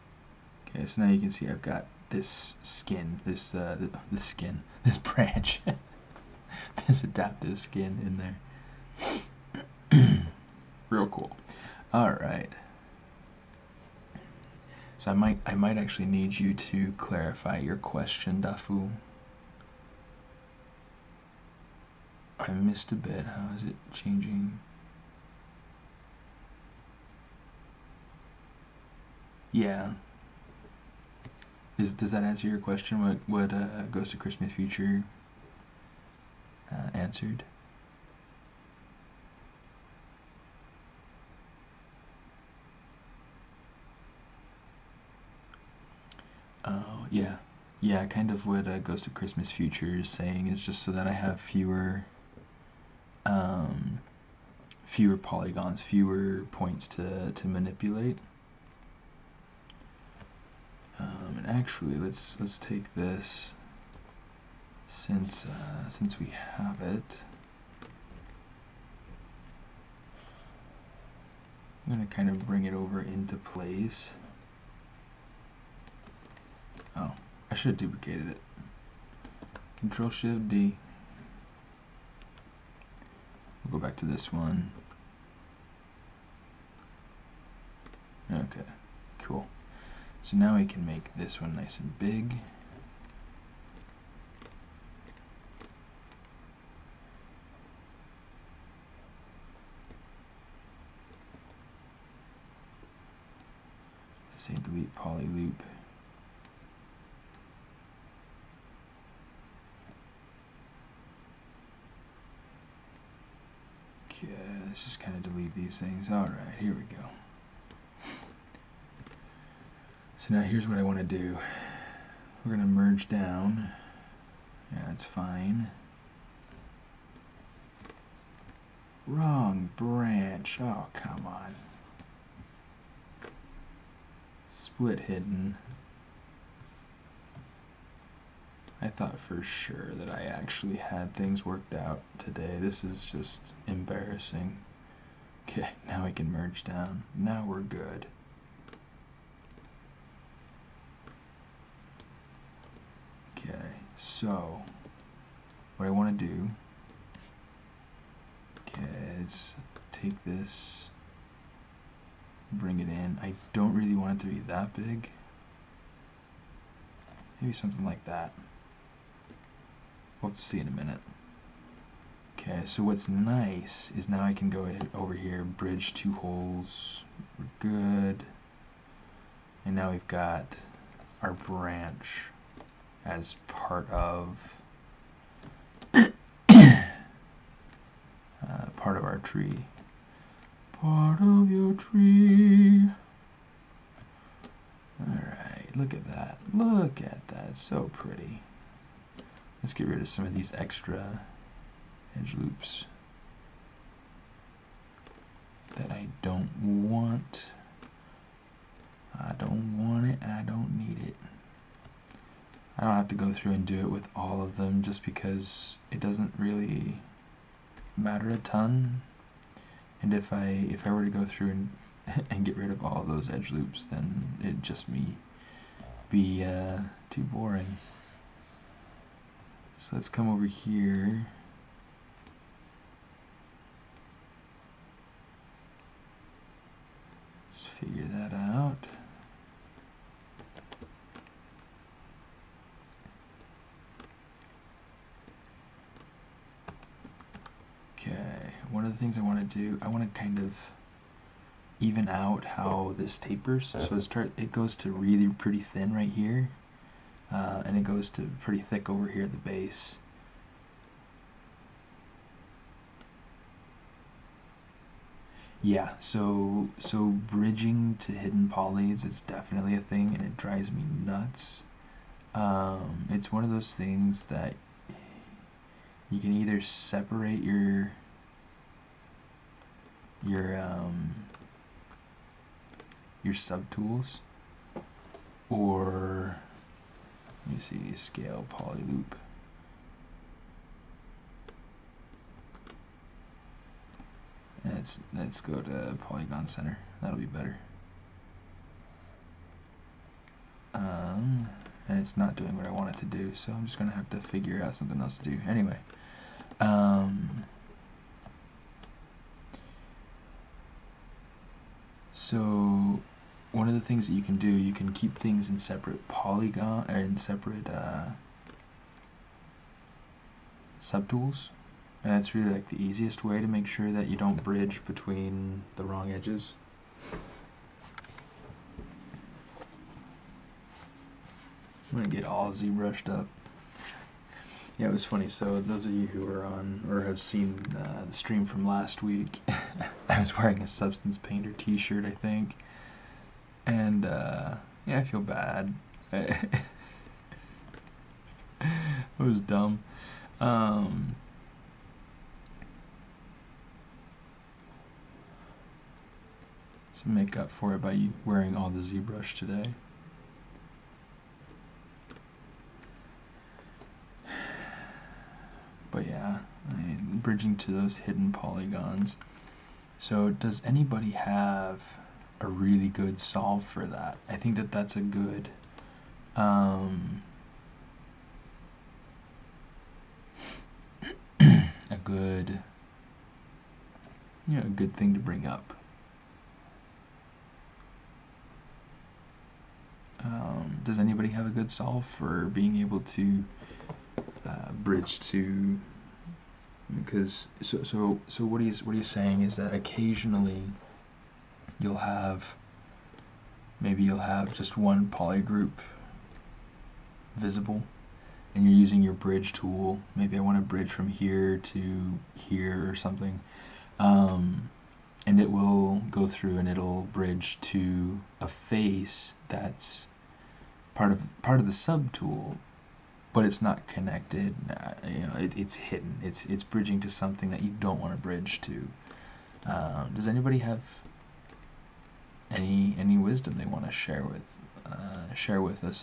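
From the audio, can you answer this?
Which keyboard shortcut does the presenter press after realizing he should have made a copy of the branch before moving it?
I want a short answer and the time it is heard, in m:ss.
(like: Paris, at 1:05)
Control Shift D, at 1:19.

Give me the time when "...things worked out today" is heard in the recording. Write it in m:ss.
2:21.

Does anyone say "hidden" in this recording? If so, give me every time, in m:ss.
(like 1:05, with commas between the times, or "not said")
2:14, 4:28, 6:07, 7:05.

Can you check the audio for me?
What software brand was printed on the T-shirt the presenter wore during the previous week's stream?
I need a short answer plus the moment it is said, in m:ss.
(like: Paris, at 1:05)
Substance Painter, at 5:40.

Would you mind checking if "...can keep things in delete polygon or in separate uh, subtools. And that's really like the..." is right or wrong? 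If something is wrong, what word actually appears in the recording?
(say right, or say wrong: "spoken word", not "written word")
wrong: "separate", not "delete".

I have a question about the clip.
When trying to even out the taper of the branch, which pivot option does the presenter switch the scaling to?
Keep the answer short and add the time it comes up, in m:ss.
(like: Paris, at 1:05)
polygon center, at 4:56.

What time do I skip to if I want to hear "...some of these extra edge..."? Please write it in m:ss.
3:20.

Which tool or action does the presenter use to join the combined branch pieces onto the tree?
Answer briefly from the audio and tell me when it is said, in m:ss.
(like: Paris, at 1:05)
bridge two holes, at 2:55.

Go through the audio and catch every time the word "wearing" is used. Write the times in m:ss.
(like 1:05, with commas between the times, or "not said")
5:40, 5:58.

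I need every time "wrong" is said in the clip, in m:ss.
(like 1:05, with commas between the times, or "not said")
2:09, 5:25.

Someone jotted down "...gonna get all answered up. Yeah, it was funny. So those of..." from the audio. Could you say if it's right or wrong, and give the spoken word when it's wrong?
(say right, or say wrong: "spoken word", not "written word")
wrong: "zbrushed", not "answered".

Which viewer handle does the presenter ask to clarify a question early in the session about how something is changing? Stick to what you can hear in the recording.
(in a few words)
Dafu.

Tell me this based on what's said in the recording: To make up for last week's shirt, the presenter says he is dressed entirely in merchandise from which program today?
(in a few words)
ZBrush.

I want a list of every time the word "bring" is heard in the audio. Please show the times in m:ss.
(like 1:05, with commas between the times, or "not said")
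1:12, 2:42, 6:25.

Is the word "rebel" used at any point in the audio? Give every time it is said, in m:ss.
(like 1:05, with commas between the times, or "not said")
not said.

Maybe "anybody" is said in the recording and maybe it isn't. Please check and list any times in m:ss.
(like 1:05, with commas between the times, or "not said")
6:10, 6:30, 7:10.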